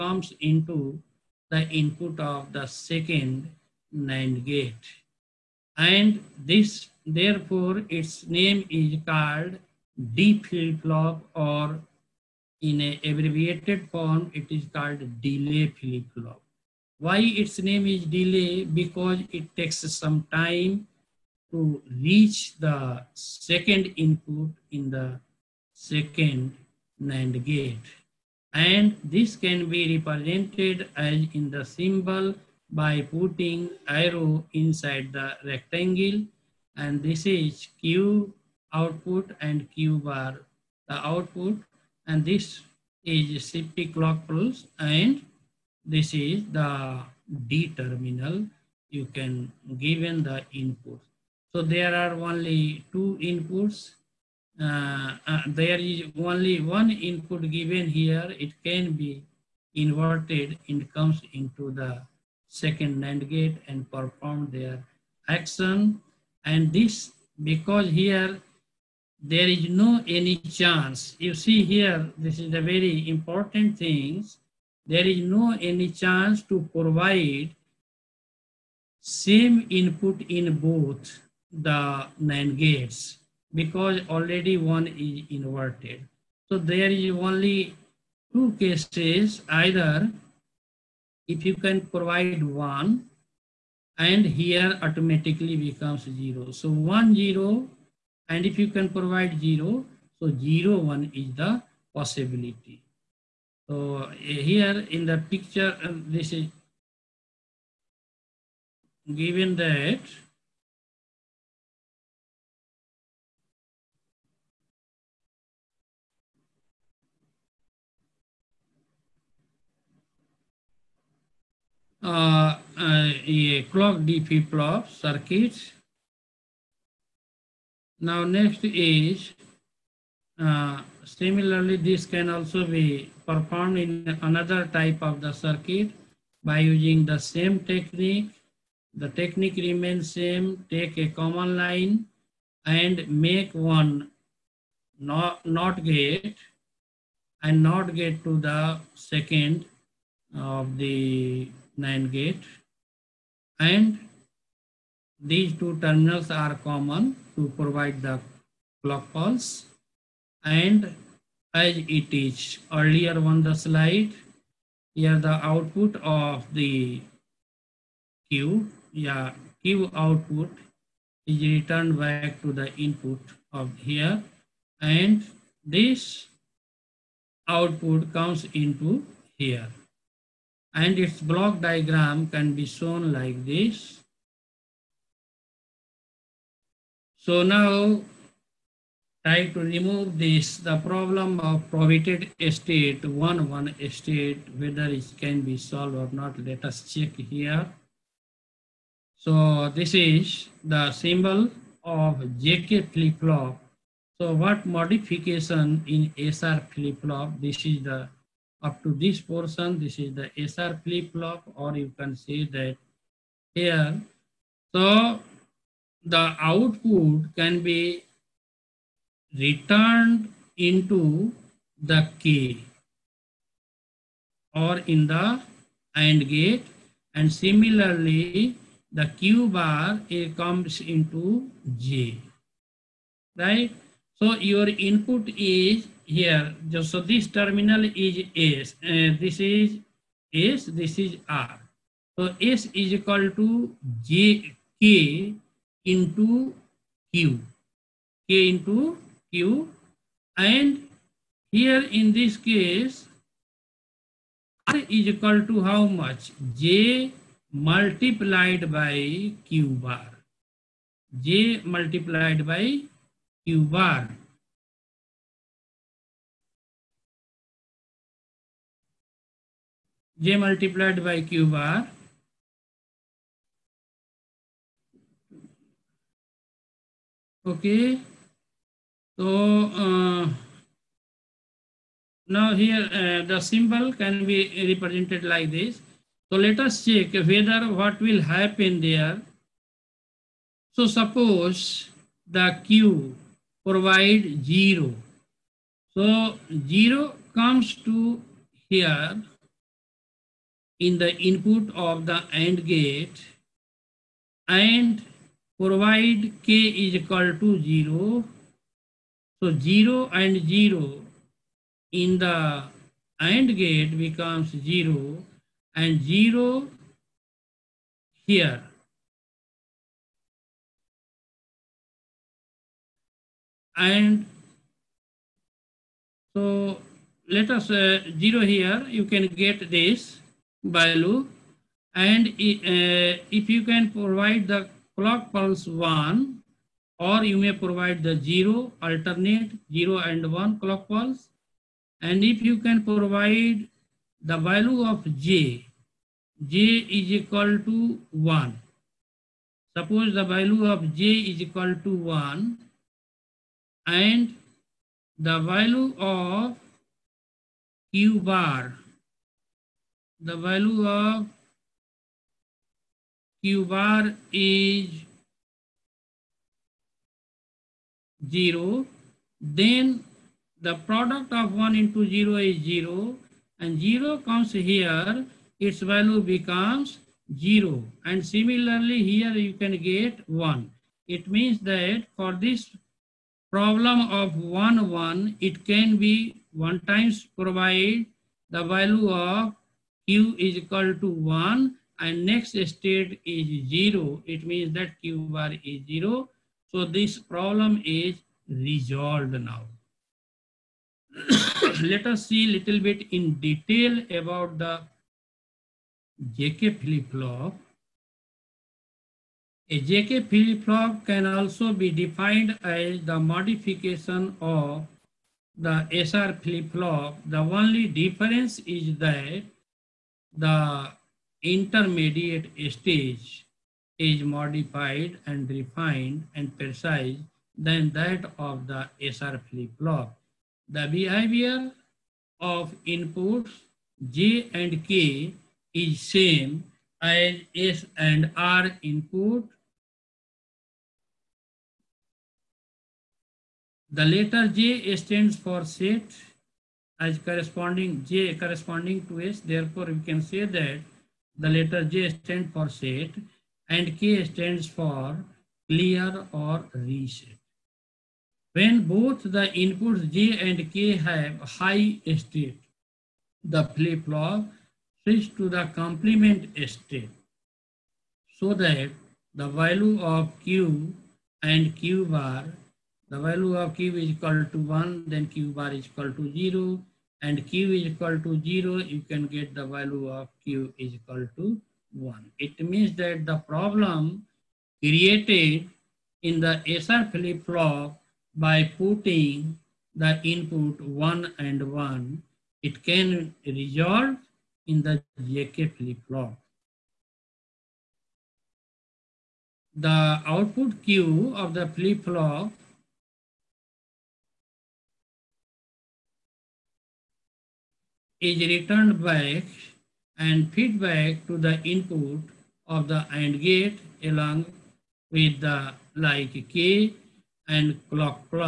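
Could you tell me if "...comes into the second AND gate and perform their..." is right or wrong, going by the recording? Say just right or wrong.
wrong.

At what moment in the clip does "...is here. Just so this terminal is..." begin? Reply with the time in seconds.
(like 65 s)
235 s.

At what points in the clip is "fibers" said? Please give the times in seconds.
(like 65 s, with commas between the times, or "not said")
not said.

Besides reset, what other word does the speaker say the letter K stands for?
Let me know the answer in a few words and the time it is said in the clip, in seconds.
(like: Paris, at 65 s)
clear, at 455 s.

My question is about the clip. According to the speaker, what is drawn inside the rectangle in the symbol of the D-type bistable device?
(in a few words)
arrow.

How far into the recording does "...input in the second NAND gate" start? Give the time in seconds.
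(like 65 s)
23 s.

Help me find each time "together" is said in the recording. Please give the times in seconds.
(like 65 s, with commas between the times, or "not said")
not said.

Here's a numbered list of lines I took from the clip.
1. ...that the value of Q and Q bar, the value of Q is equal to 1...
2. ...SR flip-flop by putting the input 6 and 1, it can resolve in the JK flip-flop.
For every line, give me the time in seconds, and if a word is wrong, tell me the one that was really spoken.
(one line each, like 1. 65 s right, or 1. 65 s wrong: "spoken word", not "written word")
1. 468 s right
2. 486 s wrong: "1", not "6".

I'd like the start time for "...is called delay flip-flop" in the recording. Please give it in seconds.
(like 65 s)
14 s.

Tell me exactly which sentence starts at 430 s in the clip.
The behavior of inputs J and K is same as S and R input.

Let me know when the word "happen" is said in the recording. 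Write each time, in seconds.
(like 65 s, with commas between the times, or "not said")
288 s.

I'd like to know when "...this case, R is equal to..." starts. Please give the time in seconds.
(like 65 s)
252 s.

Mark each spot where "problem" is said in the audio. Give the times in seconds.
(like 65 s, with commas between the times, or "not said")
190 s, 383 s, 397 s, 483 s.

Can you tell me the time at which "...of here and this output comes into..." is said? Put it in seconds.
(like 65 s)
173 s.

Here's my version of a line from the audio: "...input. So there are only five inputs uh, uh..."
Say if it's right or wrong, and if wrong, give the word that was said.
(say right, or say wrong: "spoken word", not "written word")
wrong: "two", not "five".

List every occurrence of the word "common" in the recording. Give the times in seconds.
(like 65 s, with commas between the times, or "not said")
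141 s, 156 s.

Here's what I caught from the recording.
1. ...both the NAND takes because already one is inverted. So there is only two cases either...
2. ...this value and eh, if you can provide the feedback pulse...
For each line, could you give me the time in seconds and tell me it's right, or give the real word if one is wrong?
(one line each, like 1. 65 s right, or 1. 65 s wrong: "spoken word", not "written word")
1. 80 s wrong: "gates", not "takes"
2. 329 s wrong: "clock", not "feedback".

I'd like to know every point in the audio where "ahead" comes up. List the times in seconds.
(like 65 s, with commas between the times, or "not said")
not said.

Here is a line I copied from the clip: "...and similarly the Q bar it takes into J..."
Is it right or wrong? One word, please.
wrong.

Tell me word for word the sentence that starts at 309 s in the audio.
So 0 and 0 in the AND gate becomes 0 and 0 here.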